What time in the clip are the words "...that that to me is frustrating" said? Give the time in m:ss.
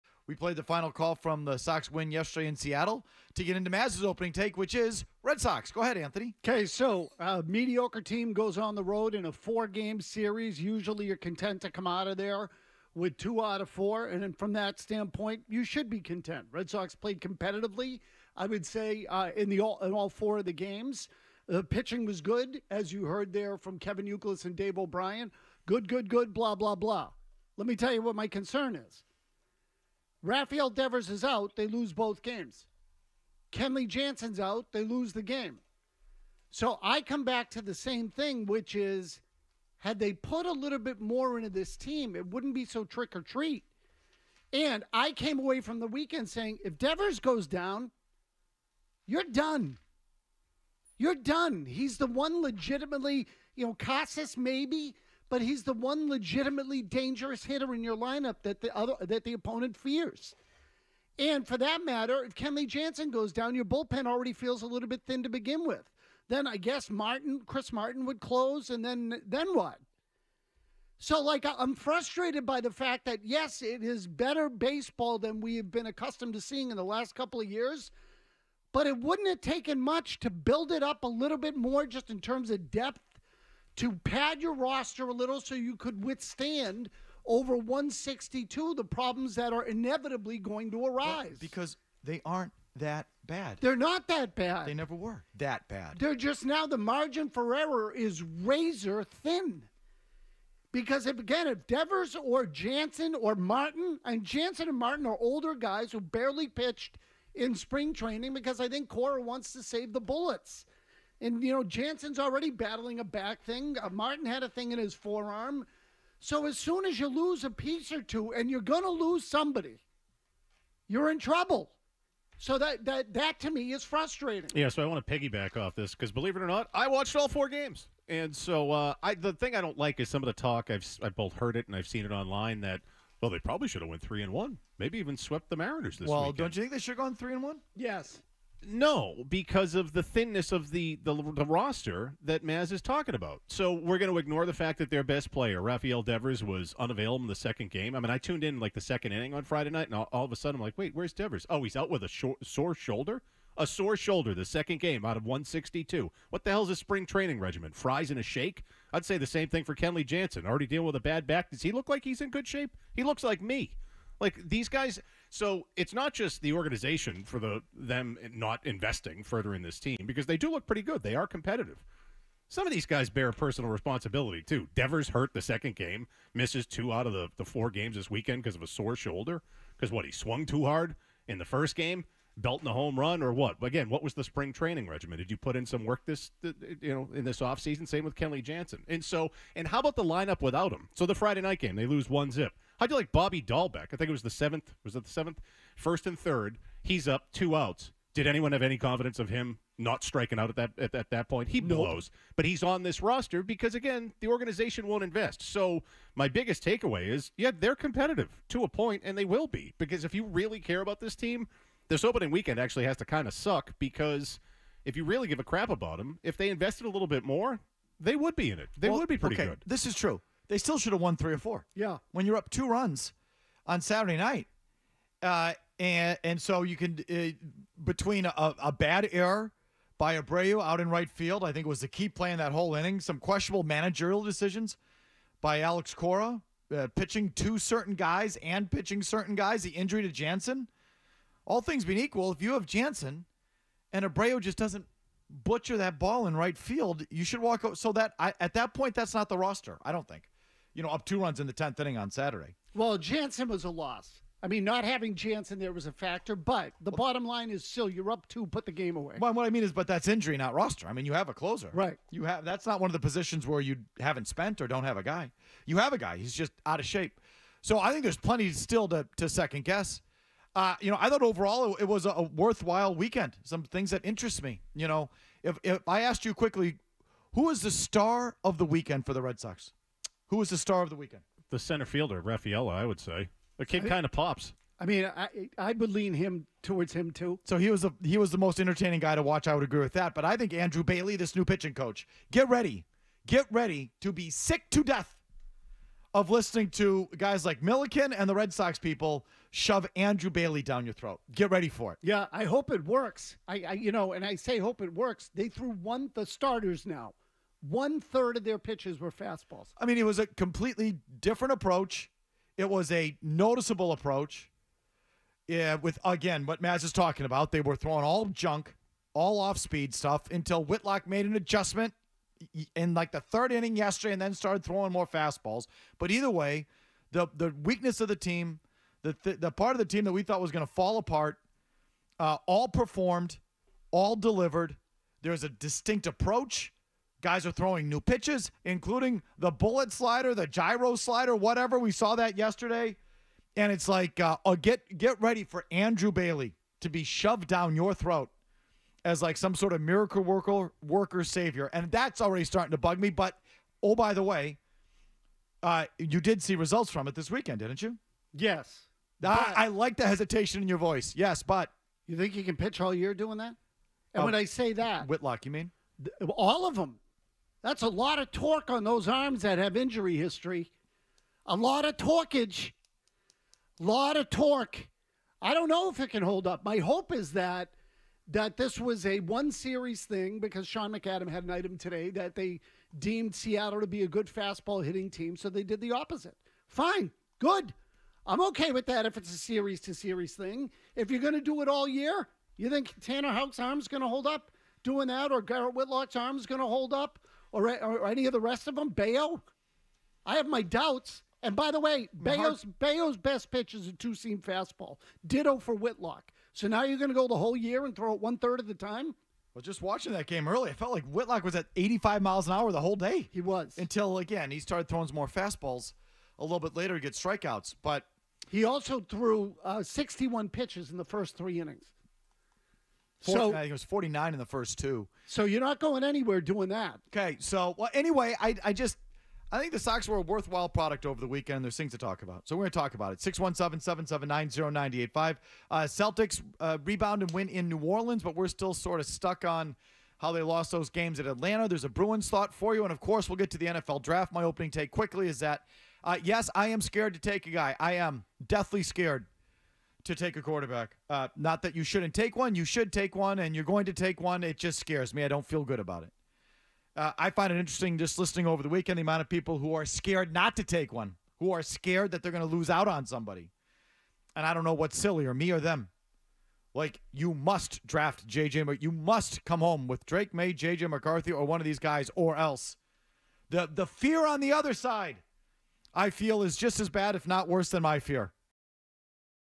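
2:02.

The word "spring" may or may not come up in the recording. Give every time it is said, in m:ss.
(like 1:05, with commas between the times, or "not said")
1:47, 2:36, 3:04.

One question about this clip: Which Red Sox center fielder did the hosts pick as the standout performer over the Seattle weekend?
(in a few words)
Rafaela.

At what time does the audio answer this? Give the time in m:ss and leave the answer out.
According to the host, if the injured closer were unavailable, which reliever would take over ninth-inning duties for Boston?
1:07.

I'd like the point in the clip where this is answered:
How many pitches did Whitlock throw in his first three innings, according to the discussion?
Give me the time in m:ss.
6:59.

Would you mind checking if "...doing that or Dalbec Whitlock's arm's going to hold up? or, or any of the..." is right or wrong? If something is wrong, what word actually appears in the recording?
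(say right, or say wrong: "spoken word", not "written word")
wrong: "Garrett", not "Dalbec".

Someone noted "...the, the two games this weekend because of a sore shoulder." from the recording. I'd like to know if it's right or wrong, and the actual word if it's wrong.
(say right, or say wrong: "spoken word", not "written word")
wrong: "four", not "two".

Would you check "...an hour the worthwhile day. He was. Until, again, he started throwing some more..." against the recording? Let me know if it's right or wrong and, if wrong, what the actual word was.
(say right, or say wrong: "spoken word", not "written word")
wrong: "whole", not "worthwhile".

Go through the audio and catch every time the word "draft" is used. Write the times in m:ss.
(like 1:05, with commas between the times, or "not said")
7:24, 7:47.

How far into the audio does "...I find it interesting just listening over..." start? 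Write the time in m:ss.
7:37.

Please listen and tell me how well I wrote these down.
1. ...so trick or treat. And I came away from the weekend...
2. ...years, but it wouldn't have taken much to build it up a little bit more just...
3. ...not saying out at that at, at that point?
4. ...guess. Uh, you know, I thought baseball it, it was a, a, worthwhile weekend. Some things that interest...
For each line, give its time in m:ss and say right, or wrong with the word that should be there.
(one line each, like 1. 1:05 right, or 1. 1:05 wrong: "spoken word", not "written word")
1. 0:42 right
2. 1:17 right
3. 3:19 wrong: "striking", not "saying"
4. 4:29 wrong: "overall", not "baseball".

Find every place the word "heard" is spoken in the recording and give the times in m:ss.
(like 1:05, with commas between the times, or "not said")
0:23, 2:11.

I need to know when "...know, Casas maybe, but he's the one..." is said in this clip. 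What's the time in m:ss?
0:53.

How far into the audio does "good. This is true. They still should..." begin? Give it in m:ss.
3:39.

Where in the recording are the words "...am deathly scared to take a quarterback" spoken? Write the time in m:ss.
7:27.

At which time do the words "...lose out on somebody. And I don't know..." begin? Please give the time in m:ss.
7:42.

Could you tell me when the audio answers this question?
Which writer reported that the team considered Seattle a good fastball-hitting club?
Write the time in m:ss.
6:20.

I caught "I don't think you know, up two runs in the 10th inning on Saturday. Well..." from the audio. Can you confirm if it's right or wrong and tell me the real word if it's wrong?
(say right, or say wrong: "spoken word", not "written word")
right.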